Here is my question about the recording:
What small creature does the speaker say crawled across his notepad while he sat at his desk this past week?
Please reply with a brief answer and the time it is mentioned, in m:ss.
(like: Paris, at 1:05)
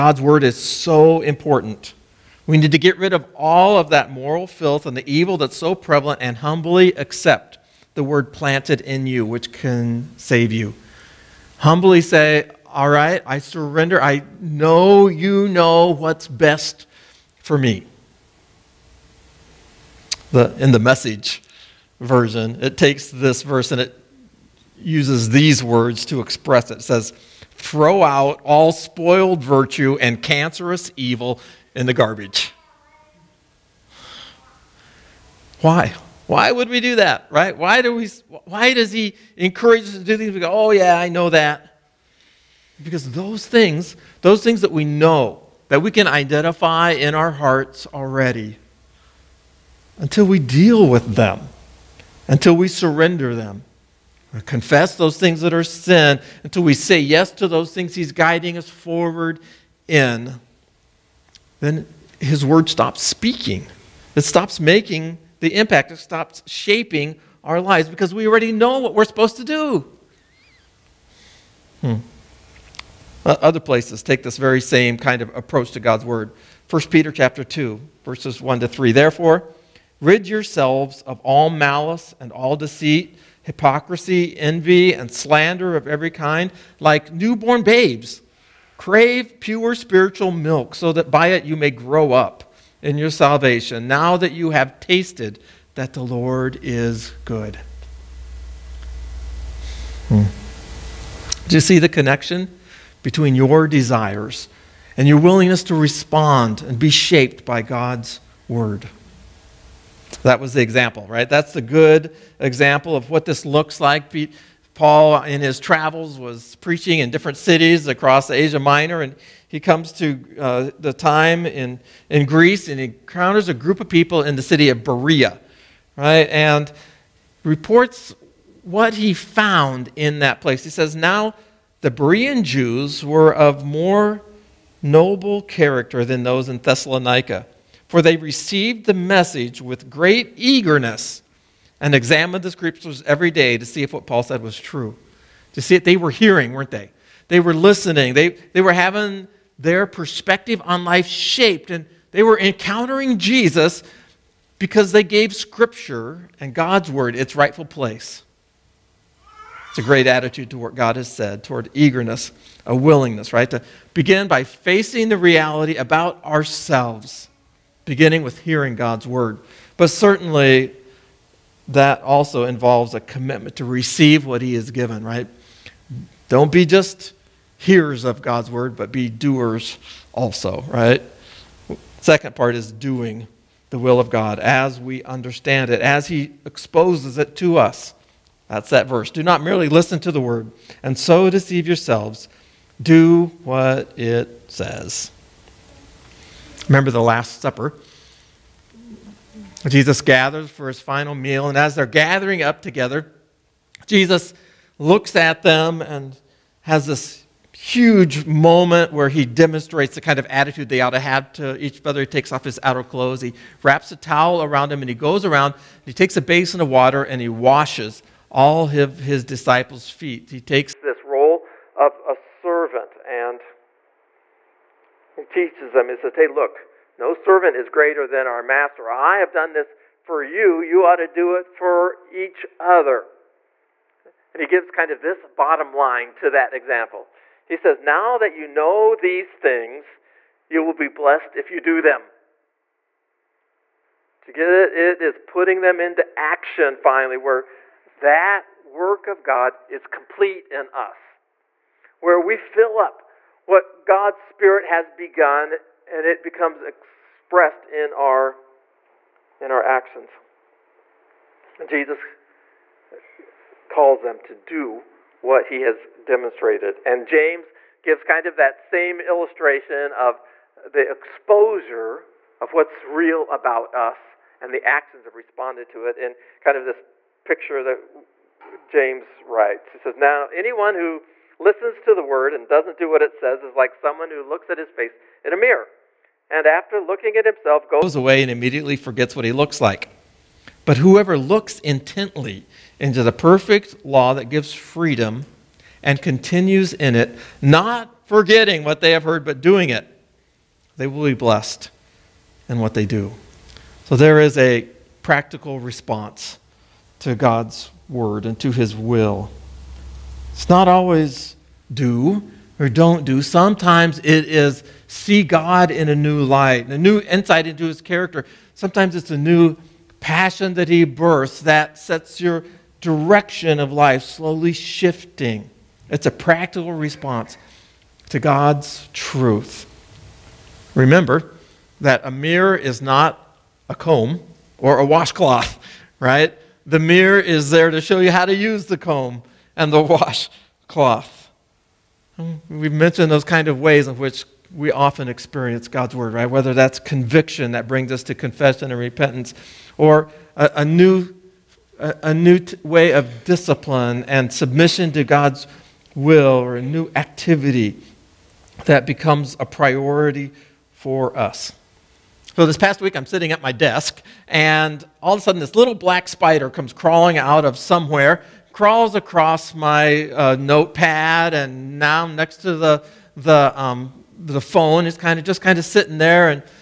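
Black spider, at 6:05.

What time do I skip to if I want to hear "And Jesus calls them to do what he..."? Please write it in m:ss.
4:21.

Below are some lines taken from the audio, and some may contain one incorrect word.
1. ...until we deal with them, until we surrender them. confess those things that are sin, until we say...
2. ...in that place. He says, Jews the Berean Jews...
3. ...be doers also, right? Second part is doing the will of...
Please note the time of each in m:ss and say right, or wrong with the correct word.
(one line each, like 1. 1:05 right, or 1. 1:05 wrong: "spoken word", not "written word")
1. 0:49 right
2. 2:09 wrong: "Now", not "Jews"
3. 2:58 right.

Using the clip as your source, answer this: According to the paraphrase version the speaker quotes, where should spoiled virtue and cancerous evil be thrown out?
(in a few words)
In the garbage.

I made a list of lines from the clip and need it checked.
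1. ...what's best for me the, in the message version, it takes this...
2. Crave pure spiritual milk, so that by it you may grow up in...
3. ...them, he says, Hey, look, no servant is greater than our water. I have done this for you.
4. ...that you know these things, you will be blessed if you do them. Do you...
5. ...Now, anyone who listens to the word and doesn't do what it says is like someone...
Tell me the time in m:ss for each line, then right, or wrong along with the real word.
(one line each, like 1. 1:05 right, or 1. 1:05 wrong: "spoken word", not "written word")
1. 0:15 right
2. 1:28 right
3. 3:45 wrong: "master", not "water"
4. 3:58 right
5. 4:39 right.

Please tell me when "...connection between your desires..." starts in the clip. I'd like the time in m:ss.
1:41.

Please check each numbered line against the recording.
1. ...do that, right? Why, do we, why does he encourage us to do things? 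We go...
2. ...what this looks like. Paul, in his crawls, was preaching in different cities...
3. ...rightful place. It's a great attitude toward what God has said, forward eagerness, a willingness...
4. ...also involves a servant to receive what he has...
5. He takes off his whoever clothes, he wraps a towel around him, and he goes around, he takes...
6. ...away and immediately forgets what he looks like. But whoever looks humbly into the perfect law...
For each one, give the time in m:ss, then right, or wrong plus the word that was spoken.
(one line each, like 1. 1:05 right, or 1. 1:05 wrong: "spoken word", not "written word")
1. 0:36 right
2. 1:53 wrong: "travels", not "crawls"
3. 2:37 wrong: "toward", not "forward"
4. 2:52 wrong: "commitment", not "servant"
5. 3:32 wrong: "outer", not "whoever"
6. 4:47 wrong: "intently", not "humbly".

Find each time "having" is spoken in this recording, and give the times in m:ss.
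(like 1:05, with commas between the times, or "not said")
2:28.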